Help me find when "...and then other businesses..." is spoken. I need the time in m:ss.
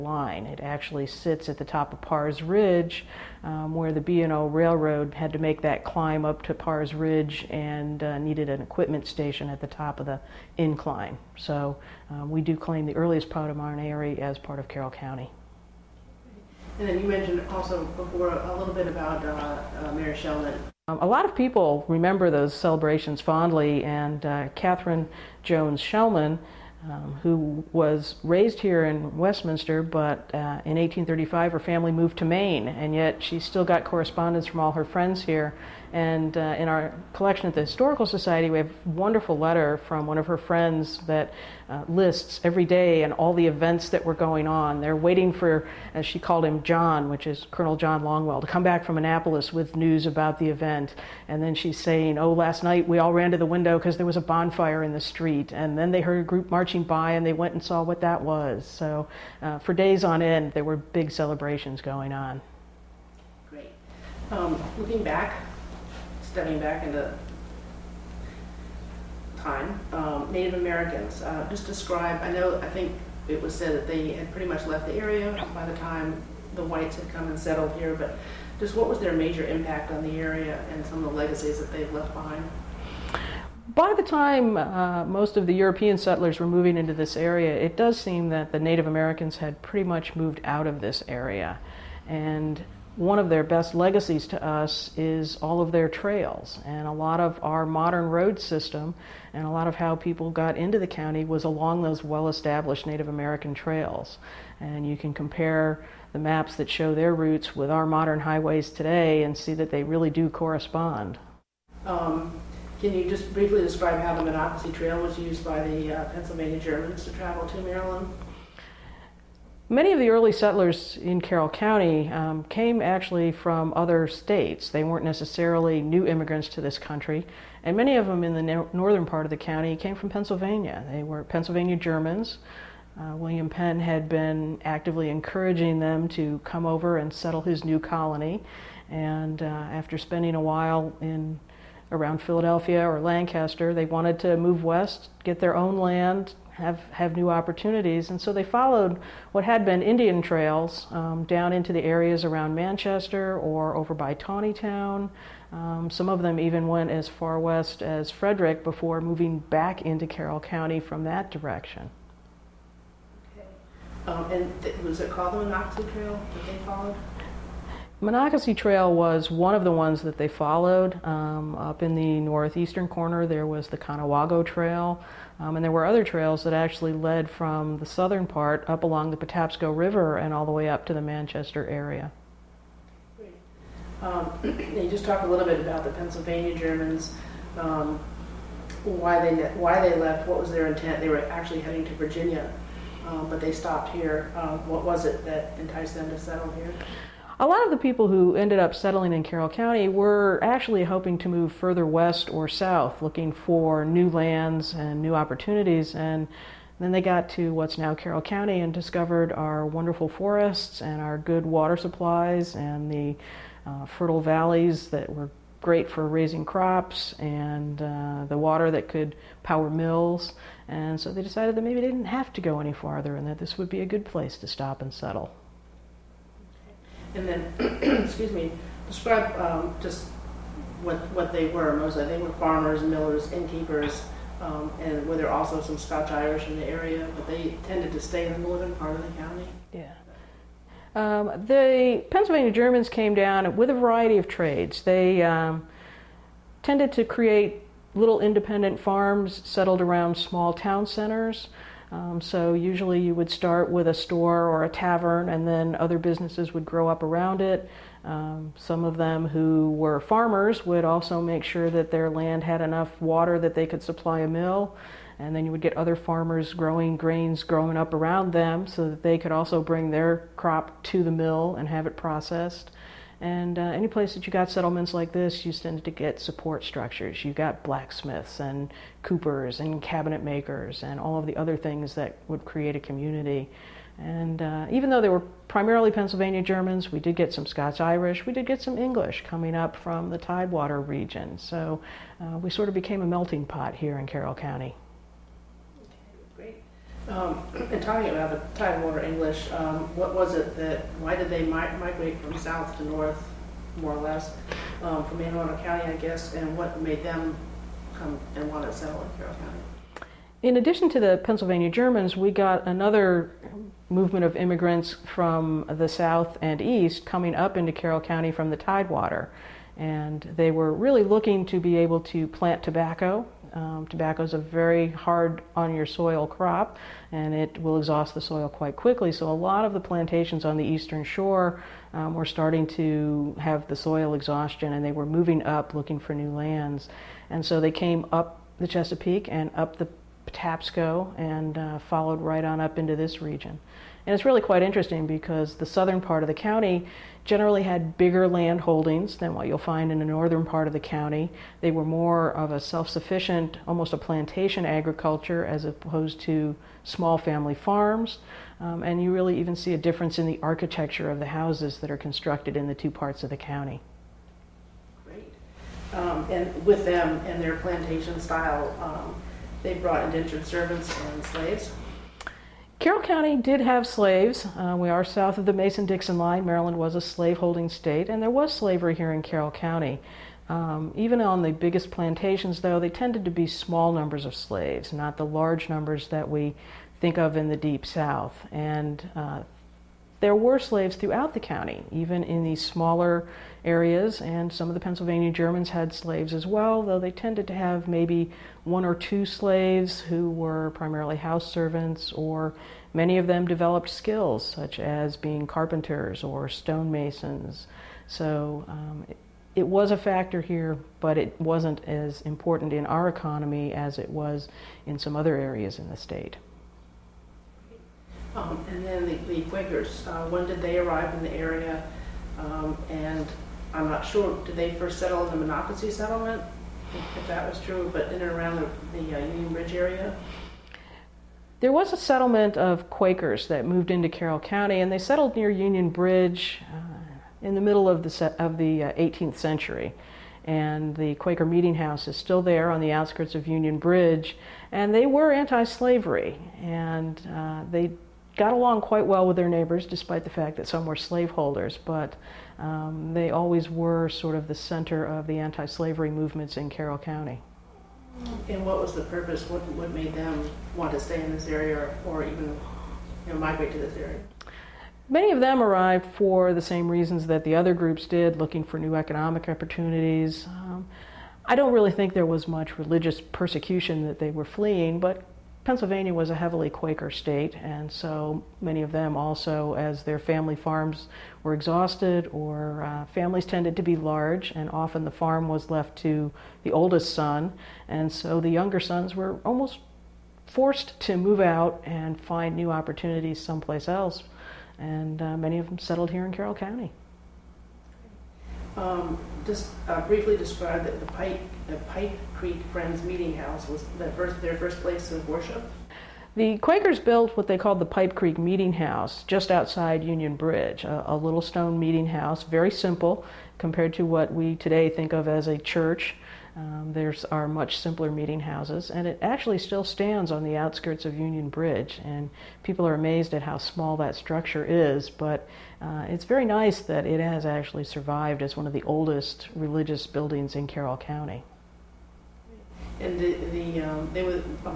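4:15.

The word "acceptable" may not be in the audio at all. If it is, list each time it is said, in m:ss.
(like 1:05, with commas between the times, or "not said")
not said.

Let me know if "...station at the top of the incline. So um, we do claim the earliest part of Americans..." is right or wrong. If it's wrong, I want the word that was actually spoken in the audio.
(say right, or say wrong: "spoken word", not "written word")
wrong: "Mount", not "Americans".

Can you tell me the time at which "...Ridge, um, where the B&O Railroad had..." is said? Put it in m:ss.
0:02.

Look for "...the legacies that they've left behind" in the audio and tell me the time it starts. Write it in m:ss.
1:21.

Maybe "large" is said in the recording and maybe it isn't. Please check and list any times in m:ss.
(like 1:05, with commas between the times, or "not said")
6:25, 8:03.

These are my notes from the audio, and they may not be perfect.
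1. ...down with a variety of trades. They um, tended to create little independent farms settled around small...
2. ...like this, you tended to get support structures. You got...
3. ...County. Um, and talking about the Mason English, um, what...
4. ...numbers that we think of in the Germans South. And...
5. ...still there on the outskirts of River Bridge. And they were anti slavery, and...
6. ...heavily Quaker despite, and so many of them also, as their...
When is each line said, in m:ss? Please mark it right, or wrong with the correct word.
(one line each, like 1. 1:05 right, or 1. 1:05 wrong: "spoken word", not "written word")
1. 4:03 right
2. 4:34 right
3. 4:54 wrong: "Tidewater", not "Mason"
4. 6:25 wrong: "Deep", not "Germans"
5. 7:22 wrong: "Union", not "River"
6. 7:56 wrong: "state", not "despite".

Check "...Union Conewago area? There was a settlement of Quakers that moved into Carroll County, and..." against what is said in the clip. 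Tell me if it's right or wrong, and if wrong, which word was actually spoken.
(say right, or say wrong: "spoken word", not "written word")
wrong: "Bridge", not "Conewago".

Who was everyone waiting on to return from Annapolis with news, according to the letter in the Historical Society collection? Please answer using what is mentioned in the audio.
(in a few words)
Colonel John Longwell.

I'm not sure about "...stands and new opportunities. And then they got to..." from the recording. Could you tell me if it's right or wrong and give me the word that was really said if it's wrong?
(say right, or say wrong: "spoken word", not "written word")
wrong: "lands", not "stands".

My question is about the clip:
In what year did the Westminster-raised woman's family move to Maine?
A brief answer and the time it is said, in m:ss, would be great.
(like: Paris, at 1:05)
1835, at 0:30.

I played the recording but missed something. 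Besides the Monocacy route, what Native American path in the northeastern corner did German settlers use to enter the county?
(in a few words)
Conewago Trail.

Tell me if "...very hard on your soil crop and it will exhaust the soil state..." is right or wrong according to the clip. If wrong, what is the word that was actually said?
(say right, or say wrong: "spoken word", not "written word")
wrong: "quite", not "state".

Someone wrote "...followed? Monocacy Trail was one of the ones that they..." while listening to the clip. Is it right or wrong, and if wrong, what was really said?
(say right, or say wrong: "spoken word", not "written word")
right.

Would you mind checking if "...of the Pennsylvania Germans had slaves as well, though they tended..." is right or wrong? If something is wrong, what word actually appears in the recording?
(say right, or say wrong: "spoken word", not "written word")
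right.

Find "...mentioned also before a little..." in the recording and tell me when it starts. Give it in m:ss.
0:17.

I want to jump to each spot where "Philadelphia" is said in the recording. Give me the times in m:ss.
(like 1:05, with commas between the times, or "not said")
2:22.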